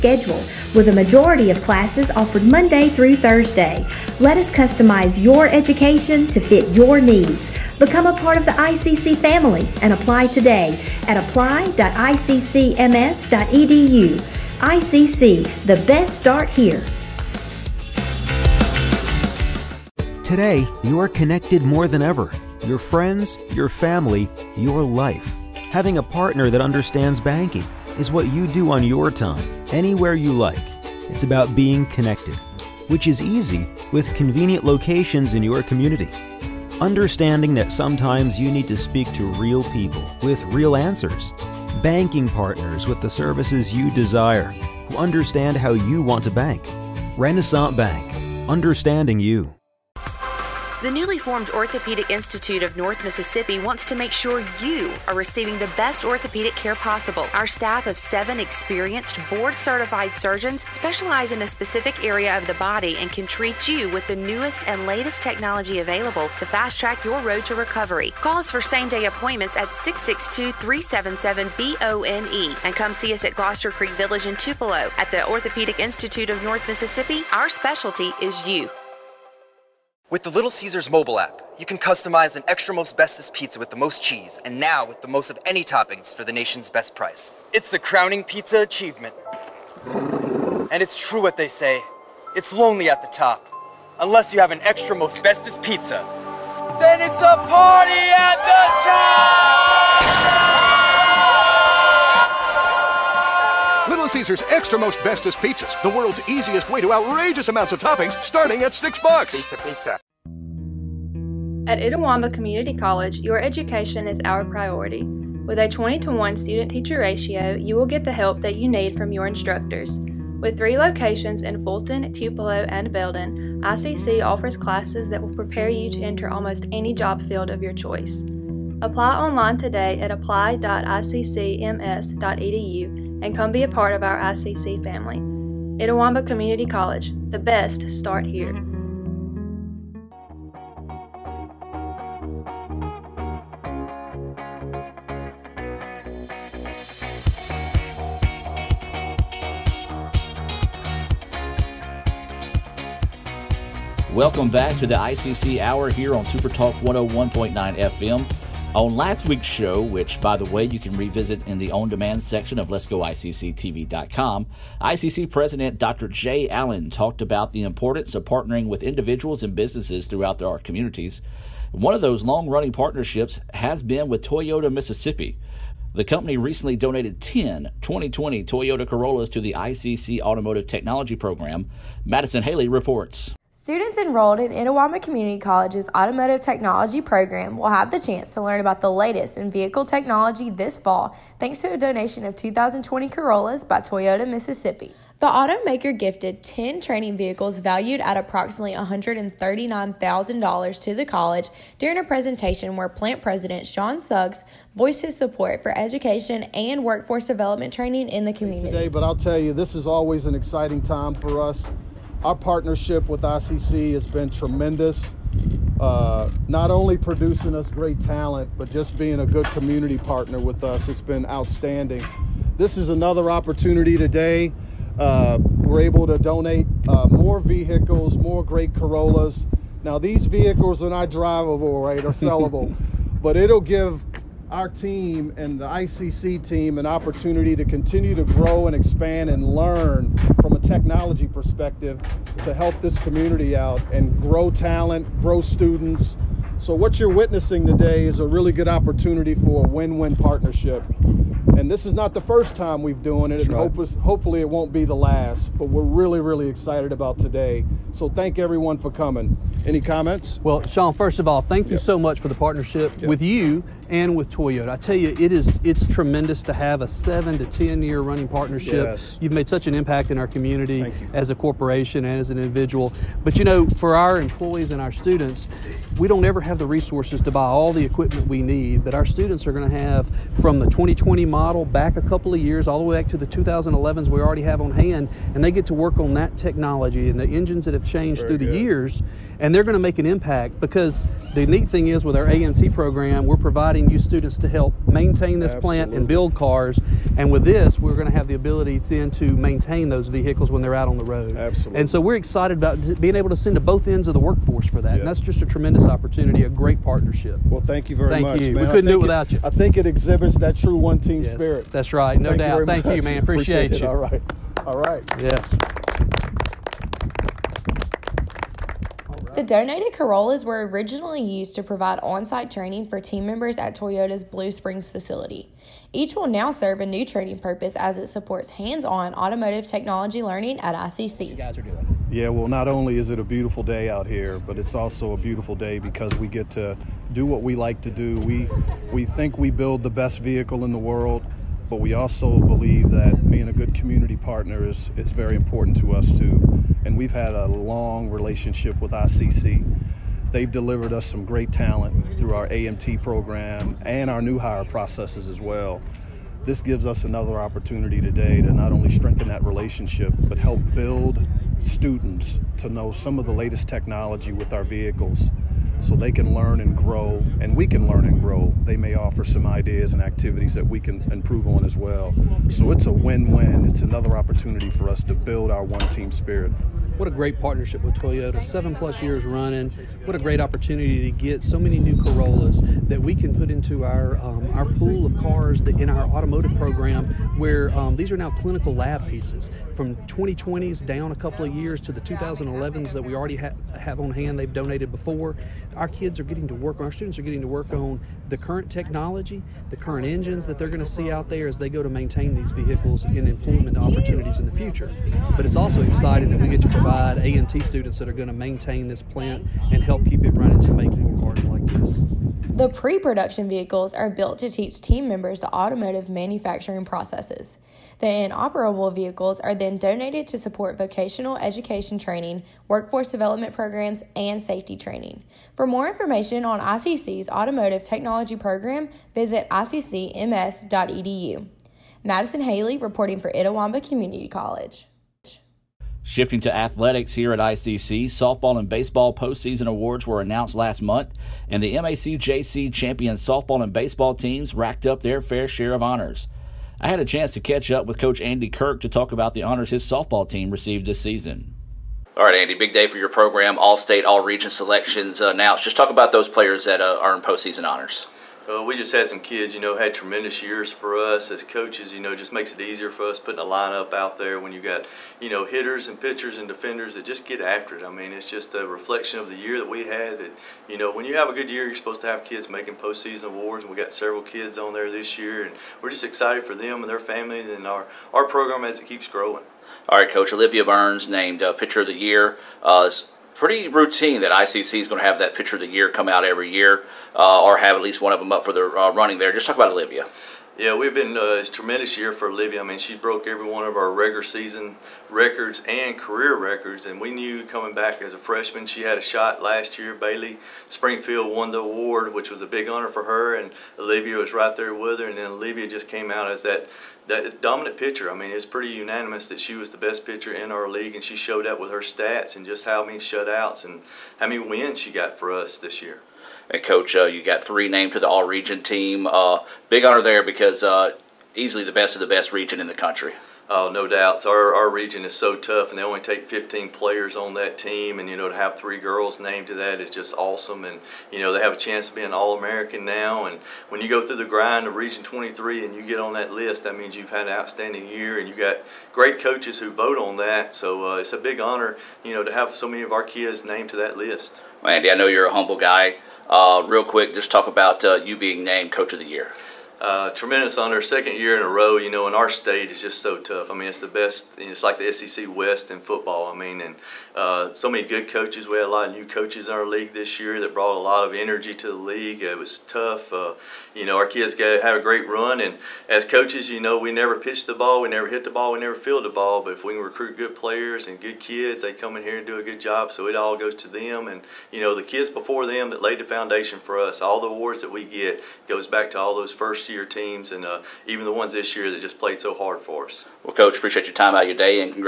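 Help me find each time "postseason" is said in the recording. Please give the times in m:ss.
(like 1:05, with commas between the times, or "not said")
7:19, 7:37, 7:52.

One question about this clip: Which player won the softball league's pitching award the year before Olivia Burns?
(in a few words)
Bailey Springfield.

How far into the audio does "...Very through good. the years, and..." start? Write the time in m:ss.
4:48.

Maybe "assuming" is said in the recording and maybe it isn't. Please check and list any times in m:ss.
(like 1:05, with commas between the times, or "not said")
not said.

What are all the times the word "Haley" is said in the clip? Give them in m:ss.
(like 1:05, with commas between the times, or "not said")
3:02, 7:12.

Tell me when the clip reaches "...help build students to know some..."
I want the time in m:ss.
6:00.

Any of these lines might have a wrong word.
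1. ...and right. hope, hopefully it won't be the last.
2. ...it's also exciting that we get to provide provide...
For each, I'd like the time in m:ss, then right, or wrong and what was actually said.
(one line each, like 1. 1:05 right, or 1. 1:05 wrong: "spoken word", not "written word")
1. 4:13 right
2. 6:45 right.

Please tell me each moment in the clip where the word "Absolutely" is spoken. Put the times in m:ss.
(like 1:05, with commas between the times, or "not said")
4:55, 5:01.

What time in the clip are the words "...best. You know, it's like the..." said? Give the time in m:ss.
9:13.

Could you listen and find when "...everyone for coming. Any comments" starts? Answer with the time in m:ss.
4:18.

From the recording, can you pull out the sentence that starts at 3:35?
Uh, not only producing us great talent, but just being a good community partner with us.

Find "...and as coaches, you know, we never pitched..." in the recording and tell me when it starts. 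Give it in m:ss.
9:25.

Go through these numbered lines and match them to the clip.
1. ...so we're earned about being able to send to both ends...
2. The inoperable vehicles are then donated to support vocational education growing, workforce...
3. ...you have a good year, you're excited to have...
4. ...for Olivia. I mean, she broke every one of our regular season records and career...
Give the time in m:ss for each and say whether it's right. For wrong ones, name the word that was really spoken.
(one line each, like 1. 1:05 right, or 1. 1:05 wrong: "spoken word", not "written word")
1. 5:01 wrong: "excited", not "earned"
2. 6:57 wrong: "training", not "growing"
3. 7:51 wrong: "supposed", not "excited"
4. 8:12 right.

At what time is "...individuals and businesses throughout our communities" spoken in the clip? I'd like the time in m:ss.
2:48.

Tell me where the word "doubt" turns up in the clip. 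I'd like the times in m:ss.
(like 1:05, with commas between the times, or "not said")
5:12, 8:43.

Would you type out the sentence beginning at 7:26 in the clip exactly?
I had a chance to catch up with Coach Andy Kirk to talk about the honors his softball team received this season.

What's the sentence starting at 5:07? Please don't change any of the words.
Well, thank you very thank much.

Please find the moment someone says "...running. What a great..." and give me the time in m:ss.
6:19.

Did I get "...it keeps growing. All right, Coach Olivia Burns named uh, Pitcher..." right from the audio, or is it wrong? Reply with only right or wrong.
right.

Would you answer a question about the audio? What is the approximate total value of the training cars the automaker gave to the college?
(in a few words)
$139,000.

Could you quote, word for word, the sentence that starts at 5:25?
Each will now serve a new training purpose as it supports hands on automotive technology learning at ICC.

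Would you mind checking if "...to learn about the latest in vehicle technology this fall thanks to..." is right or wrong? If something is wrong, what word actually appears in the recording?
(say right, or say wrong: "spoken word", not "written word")
right.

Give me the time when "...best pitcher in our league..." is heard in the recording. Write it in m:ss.
8:29.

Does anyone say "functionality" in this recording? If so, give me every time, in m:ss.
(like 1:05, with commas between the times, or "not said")
not said.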